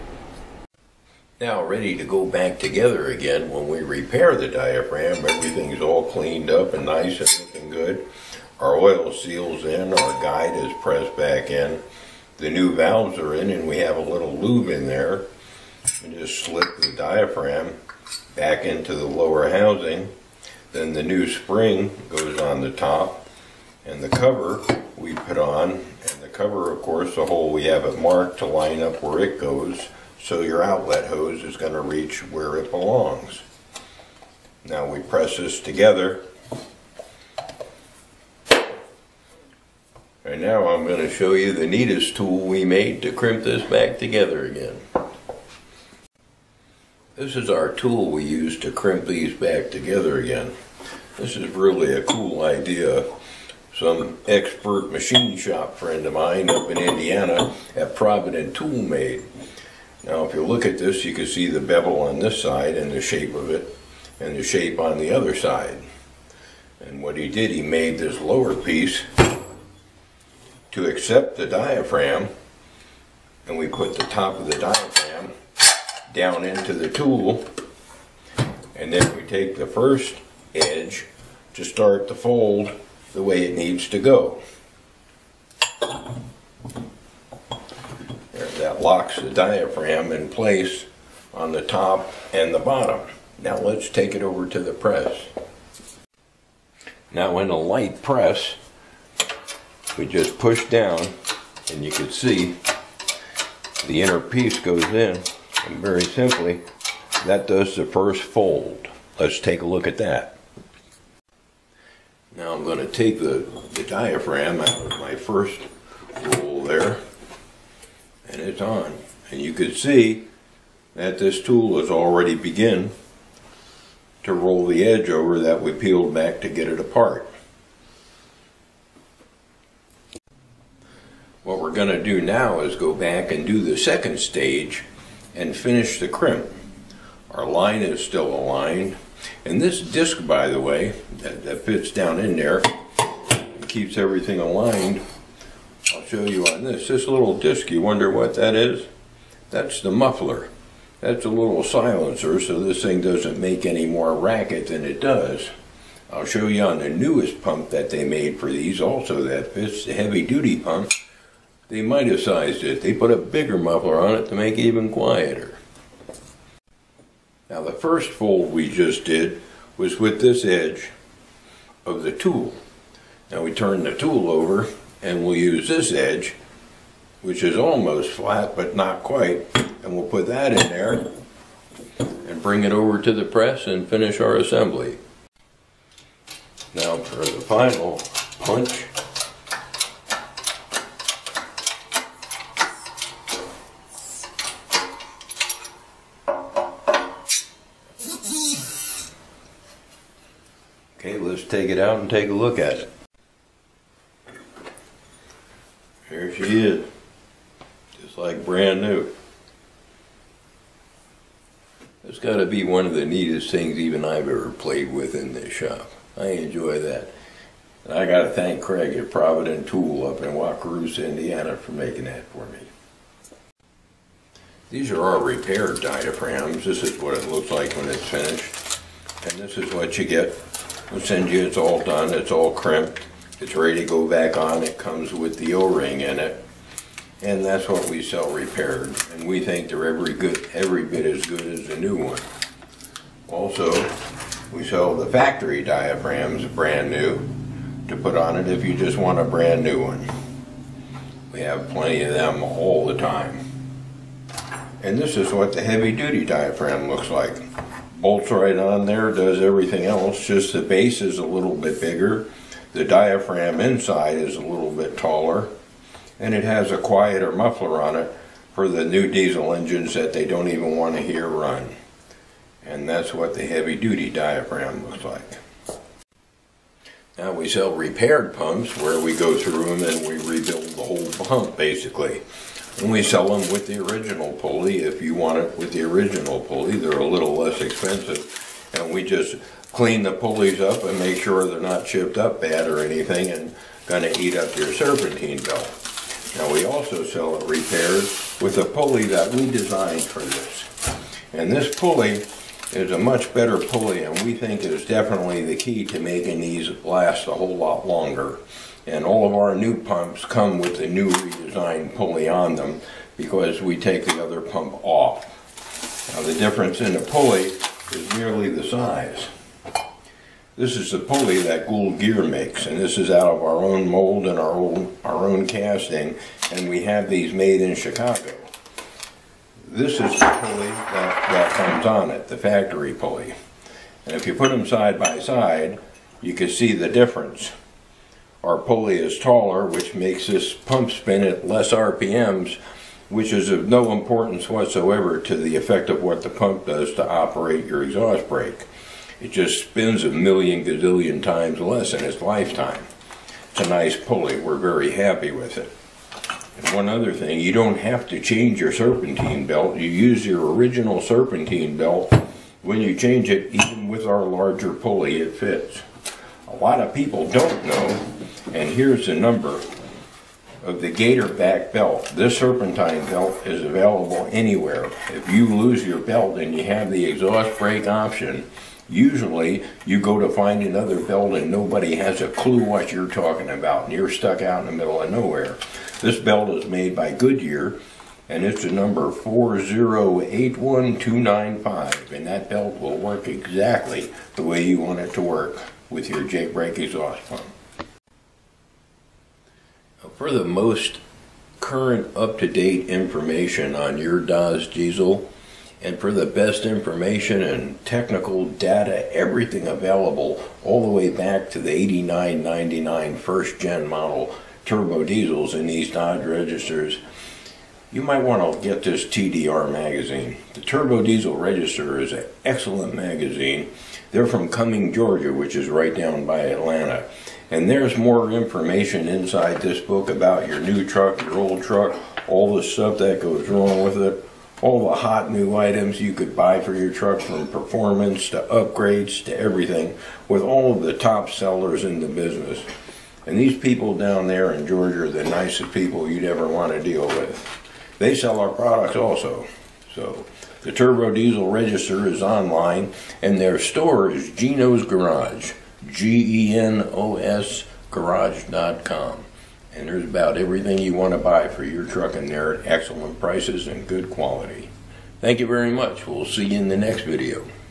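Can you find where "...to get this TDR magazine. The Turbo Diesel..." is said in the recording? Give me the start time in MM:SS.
06:58.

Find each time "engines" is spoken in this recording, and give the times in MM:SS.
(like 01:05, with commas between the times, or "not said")
04:29.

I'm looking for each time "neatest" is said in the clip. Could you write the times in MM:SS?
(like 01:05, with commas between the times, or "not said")
00:41, 03:33.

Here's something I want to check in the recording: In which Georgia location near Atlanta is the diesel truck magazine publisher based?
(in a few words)
Cumming, Georgia.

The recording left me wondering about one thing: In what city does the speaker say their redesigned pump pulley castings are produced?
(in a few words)
Chicago.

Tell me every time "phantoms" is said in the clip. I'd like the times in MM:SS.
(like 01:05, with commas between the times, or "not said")
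not said.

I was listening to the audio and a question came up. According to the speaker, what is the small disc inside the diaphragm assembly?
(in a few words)
The muffler.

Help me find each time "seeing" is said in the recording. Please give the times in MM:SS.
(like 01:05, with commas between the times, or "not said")
not said.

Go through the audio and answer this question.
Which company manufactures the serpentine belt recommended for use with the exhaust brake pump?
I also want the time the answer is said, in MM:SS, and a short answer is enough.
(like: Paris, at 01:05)
Goodyear, at 06:27.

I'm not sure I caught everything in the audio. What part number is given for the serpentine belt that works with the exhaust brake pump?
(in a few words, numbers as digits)
4081295.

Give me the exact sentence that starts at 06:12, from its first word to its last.
This serpentine belt is available anywhere.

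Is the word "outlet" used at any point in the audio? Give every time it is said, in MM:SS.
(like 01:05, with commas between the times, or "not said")
00:30.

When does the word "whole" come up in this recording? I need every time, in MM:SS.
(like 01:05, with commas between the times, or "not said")
04:40, 05:07.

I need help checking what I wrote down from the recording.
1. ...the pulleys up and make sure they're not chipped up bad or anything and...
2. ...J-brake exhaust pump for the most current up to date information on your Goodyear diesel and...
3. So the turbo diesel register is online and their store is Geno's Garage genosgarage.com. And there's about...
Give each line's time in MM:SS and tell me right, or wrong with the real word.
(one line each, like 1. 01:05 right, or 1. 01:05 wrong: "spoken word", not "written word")
1. 04:50 right
2. 06:36 wrong: "Dodge", not "Goodyear"
3. 07:29 right.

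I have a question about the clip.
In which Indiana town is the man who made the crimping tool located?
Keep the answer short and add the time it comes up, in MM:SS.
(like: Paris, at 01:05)
Wakarusa, at 03:40.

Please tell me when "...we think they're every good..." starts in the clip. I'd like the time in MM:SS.
03:59.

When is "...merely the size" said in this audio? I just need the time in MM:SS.
05:18.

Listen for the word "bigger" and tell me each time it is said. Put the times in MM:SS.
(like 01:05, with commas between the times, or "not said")
02:43, 04:21.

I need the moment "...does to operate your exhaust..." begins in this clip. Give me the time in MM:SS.
05:46.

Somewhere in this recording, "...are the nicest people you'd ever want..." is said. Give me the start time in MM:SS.
07:25.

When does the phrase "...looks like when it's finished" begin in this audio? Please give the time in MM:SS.
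03:47.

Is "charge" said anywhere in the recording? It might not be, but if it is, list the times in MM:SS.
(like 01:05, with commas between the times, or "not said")
not said.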